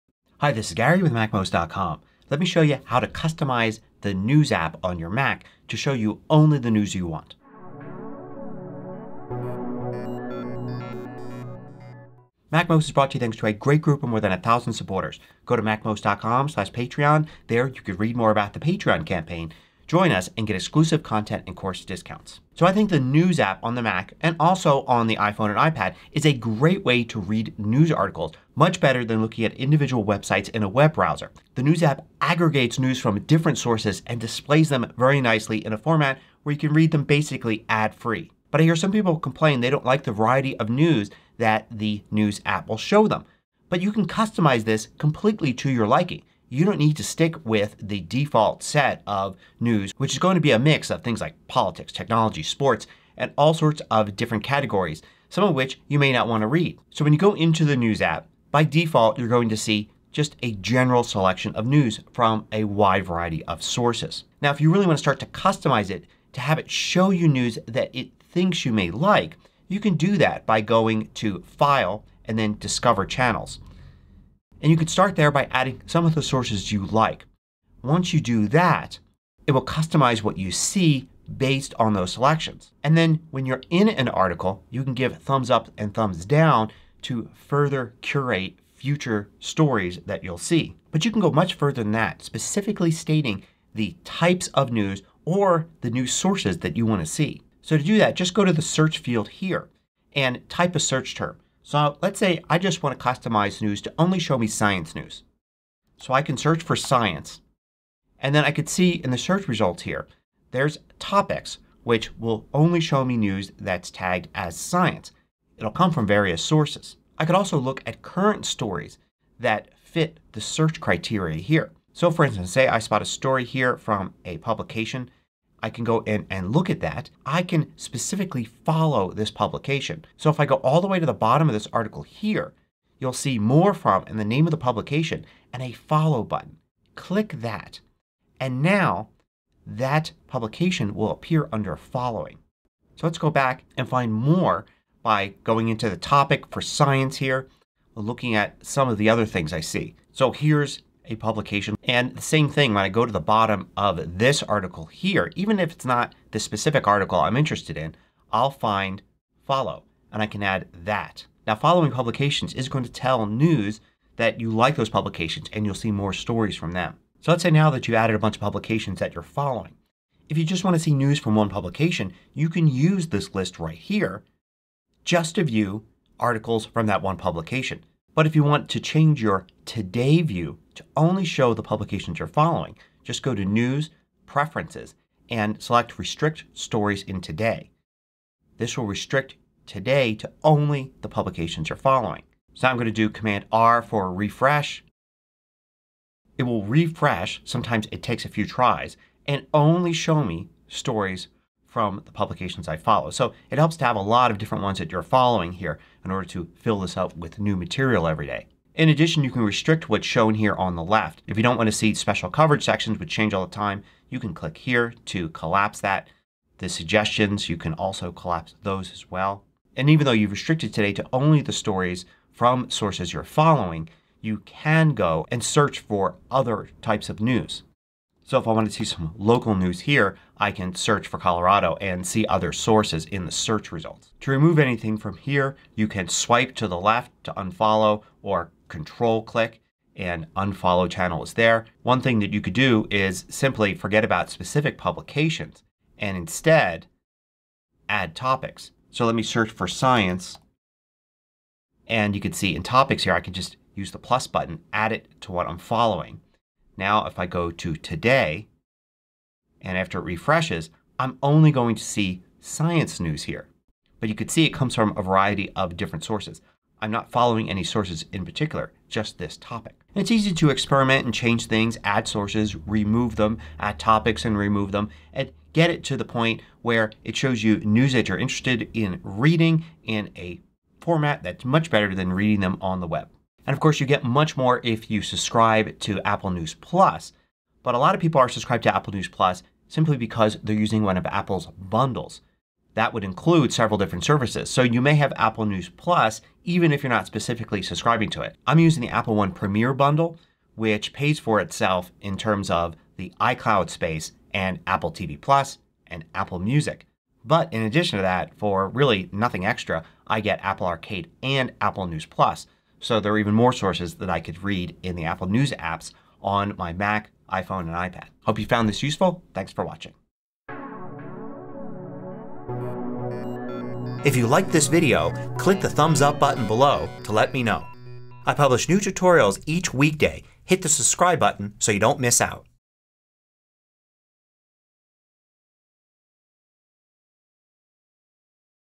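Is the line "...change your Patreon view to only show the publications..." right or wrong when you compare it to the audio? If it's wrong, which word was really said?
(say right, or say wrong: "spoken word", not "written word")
wrong: "Today", not "Patreon".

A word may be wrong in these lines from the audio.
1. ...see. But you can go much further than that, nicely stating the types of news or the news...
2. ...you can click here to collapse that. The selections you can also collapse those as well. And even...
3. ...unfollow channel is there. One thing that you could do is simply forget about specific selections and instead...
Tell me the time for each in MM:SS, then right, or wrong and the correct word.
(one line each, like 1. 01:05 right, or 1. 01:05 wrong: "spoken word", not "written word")
1. 01:30 wrong: "specifically", not "nicely"
2. 03:34 wrong: "suggestions", not "selections"
3. 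04:00 wrong: "publications", not "selections".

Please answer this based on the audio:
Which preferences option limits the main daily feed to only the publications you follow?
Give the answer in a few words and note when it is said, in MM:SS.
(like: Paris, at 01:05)
Restrict Stories in Today, at 03:05.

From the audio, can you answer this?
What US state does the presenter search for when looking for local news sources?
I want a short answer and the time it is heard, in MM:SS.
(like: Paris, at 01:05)
Colorado, at 03:51.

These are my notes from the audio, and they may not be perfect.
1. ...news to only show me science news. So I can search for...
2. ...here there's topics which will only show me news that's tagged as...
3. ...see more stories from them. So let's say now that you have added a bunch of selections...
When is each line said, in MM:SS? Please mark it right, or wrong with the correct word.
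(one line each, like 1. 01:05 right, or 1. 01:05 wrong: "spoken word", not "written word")
1. 01:43 right
2. 01:49 right
3. 02:45 wrong: "publications", not "selections".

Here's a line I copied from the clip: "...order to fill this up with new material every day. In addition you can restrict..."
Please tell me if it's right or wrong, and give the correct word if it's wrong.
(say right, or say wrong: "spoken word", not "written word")
right.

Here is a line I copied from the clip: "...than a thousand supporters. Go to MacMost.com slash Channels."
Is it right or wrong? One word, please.
wrong.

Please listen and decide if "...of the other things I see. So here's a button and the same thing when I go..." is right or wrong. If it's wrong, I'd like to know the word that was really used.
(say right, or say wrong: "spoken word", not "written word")
wrong: "publication", not "button".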